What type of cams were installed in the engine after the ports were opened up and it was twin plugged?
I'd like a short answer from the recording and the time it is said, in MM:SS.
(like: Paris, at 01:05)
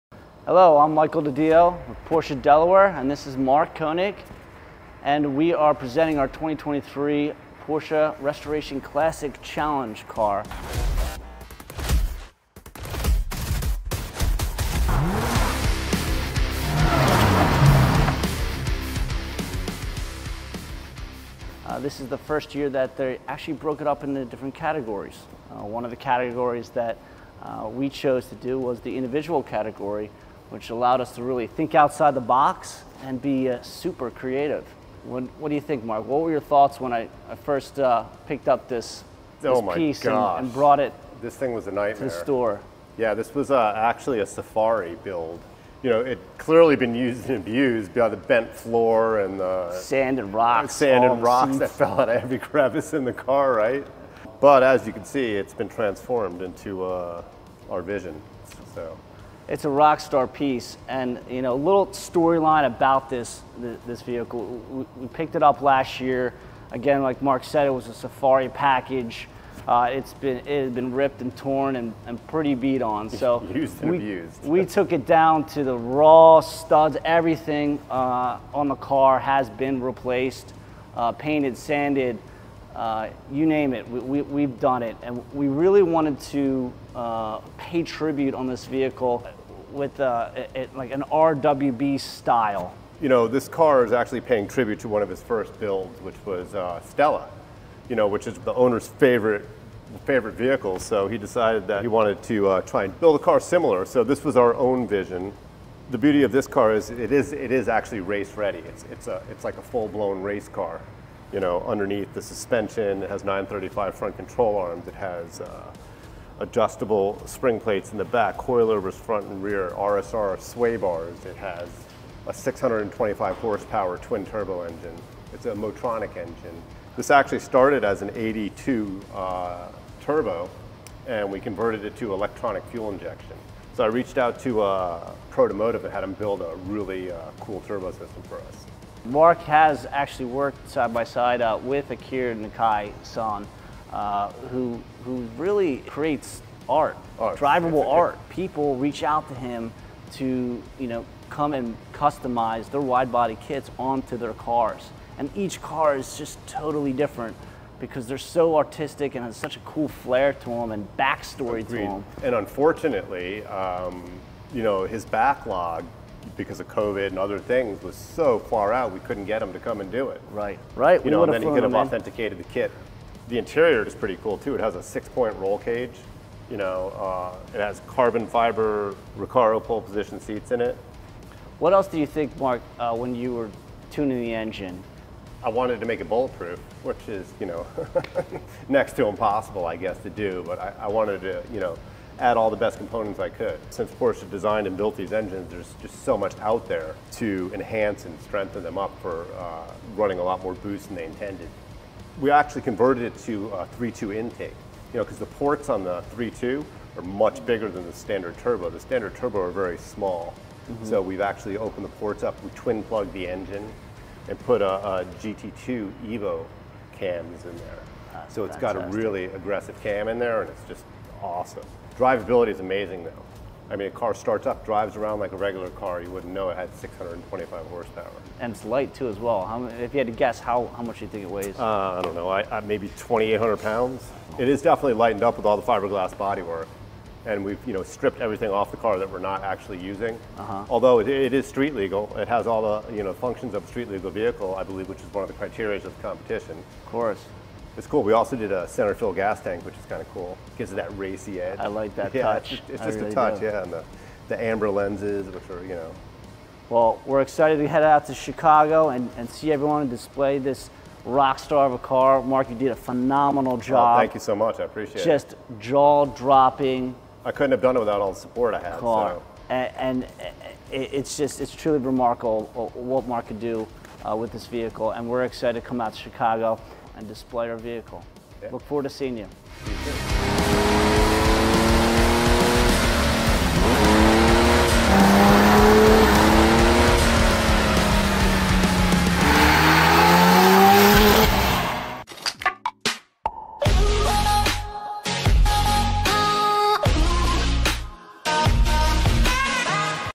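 GT2 Evo cams, at 03:35.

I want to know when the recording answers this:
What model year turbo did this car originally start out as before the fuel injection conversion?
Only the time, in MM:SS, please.
02:08.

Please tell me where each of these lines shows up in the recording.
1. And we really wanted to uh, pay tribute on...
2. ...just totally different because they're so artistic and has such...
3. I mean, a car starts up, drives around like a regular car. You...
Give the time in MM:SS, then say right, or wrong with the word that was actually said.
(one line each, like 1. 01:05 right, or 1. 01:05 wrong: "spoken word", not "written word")
1. 01:25 right
2. 02:36 right
3. 03:43 right.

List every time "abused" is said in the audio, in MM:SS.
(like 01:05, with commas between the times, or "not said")
00:47, 01:13.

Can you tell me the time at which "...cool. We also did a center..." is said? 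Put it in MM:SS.
04:07.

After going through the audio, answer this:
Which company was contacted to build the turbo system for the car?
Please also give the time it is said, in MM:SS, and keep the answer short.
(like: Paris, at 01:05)
Protomotive, at 02:15.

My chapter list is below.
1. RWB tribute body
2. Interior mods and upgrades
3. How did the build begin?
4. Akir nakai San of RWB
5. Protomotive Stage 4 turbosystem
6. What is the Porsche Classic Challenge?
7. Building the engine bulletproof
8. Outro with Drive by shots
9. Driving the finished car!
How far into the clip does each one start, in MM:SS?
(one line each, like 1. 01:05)
1. 01:32
2. 02:54
3. 00:38
4. 02:24
5. 02:03
6. 00:21
7. 03:11
8. 04:40
9. 03:45.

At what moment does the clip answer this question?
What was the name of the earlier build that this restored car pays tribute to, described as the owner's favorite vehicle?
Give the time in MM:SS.
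01:36.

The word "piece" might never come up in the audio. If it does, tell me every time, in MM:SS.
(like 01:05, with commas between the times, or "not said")
00:39, 01:00.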